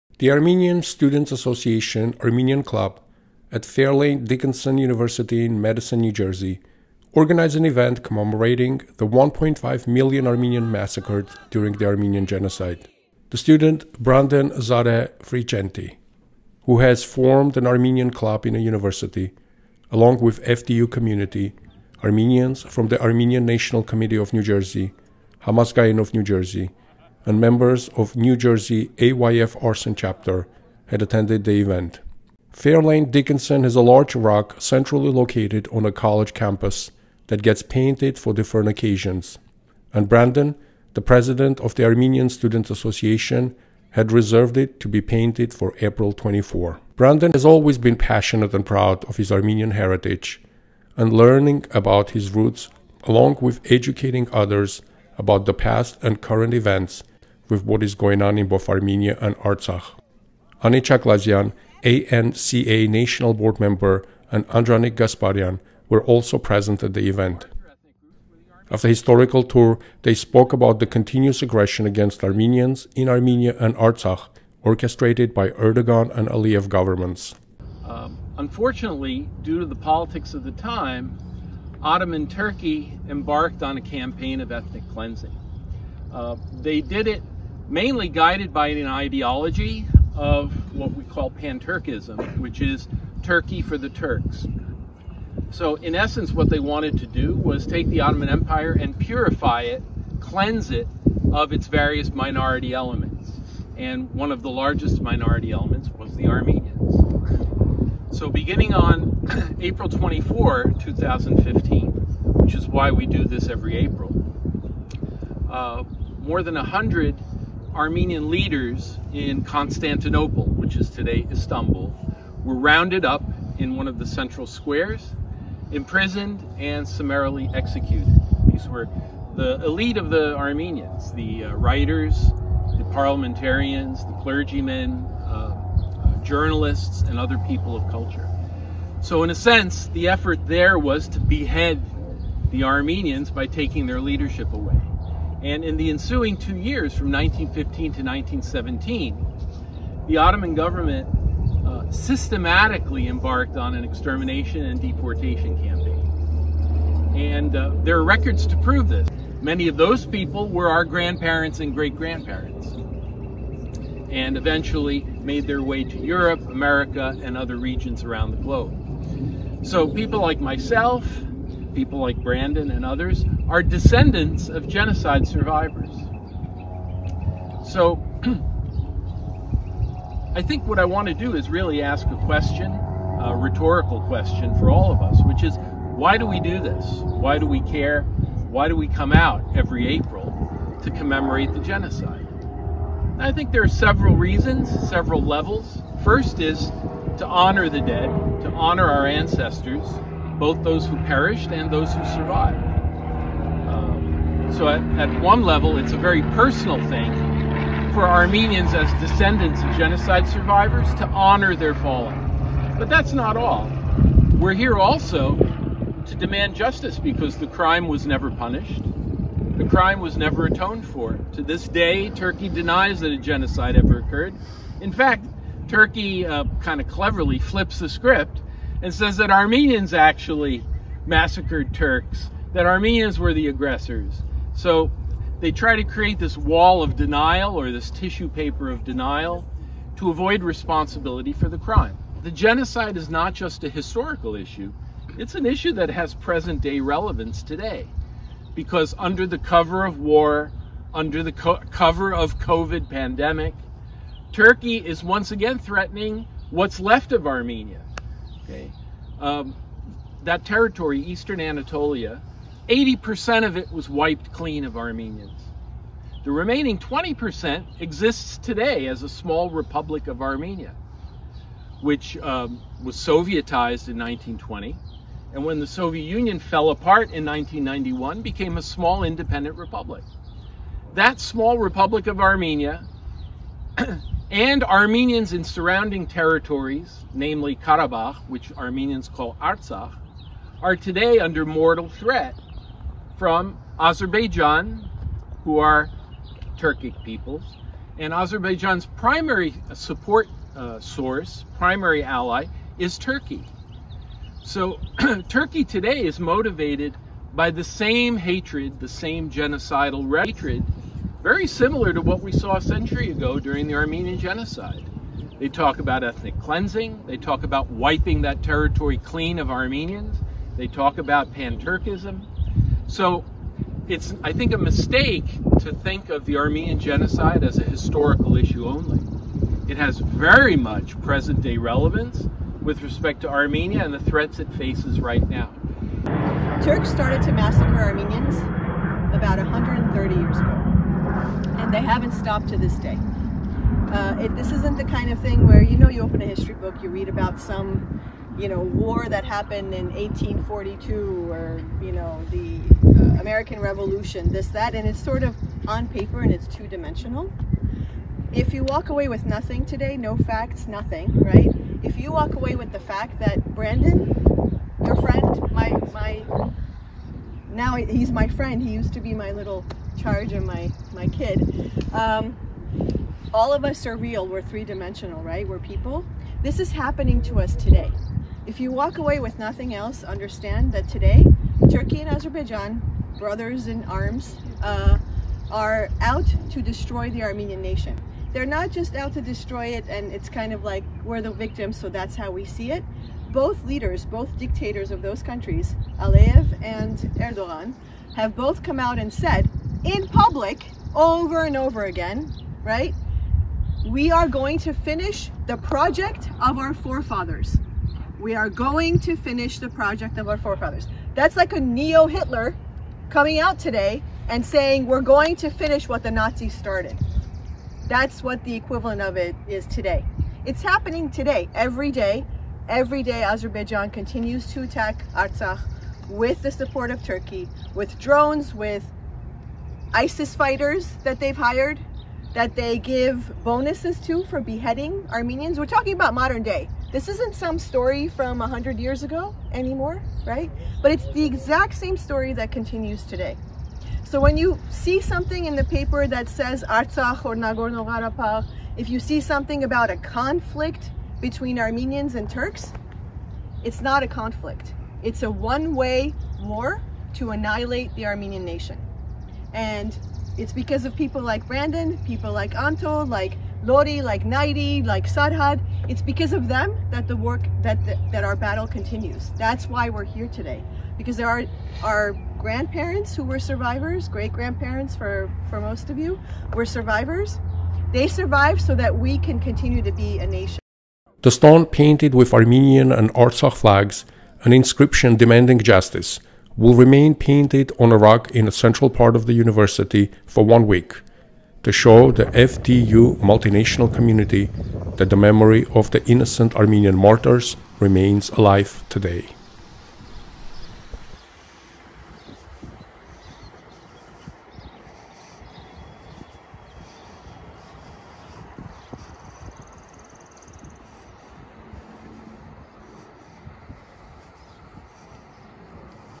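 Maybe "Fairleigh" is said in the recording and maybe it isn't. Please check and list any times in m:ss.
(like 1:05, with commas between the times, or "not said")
0:03, 0:32.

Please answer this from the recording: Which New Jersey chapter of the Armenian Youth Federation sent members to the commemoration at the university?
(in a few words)
Arsen Chapter.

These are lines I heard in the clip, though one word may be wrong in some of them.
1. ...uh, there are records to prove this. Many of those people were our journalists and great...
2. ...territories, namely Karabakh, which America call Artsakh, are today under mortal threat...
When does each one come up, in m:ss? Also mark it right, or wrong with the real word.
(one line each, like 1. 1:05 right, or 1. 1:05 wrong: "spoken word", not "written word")
1. 2:37 wrong: "grandparents", not "journalists"
2. 4:46 wrong: "Armenians", not "America".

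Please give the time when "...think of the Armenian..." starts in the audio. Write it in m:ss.
5:25.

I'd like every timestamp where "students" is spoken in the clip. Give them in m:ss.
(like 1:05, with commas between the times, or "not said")
0:00, 0:13, 0:42.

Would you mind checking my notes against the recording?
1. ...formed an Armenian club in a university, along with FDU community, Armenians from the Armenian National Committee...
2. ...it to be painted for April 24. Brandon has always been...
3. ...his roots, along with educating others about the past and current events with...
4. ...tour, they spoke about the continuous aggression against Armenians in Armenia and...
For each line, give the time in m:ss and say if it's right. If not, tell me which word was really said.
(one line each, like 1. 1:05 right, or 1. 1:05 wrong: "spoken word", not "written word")
1. 0:17 right
2. 0:44 right
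3. 0:52 right
4. 1:09 right.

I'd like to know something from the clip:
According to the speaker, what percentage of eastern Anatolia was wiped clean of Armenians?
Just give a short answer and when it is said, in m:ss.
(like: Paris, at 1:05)
80%, at 4:22.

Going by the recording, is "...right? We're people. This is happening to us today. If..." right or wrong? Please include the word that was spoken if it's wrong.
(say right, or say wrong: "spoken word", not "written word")
right.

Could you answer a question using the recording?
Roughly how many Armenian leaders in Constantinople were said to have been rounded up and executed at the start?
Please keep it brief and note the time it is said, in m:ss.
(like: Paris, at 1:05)
More than 100, at 1:56.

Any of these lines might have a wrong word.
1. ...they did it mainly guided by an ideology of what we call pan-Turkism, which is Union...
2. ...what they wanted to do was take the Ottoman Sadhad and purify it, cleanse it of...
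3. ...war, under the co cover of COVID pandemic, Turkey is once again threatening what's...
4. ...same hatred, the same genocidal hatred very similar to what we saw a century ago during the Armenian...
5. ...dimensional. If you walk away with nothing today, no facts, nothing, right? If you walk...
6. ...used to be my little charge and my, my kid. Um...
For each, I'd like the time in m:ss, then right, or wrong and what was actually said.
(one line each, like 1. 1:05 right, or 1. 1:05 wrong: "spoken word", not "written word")
1. 1:26 wrong: "Turkey", not "Union"
2. 1:36 wrong: "Empire", not "Sadhad"
3. 4:09 right
4. 5:07 right
5. 5:56 right
6. 6:08 right.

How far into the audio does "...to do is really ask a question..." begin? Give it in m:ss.
3:01.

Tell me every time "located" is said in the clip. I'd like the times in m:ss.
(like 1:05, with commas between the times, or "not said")
0:35.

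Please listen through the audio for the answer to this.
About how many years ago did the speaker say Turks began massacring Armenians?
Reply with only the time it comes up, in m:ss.
5:39.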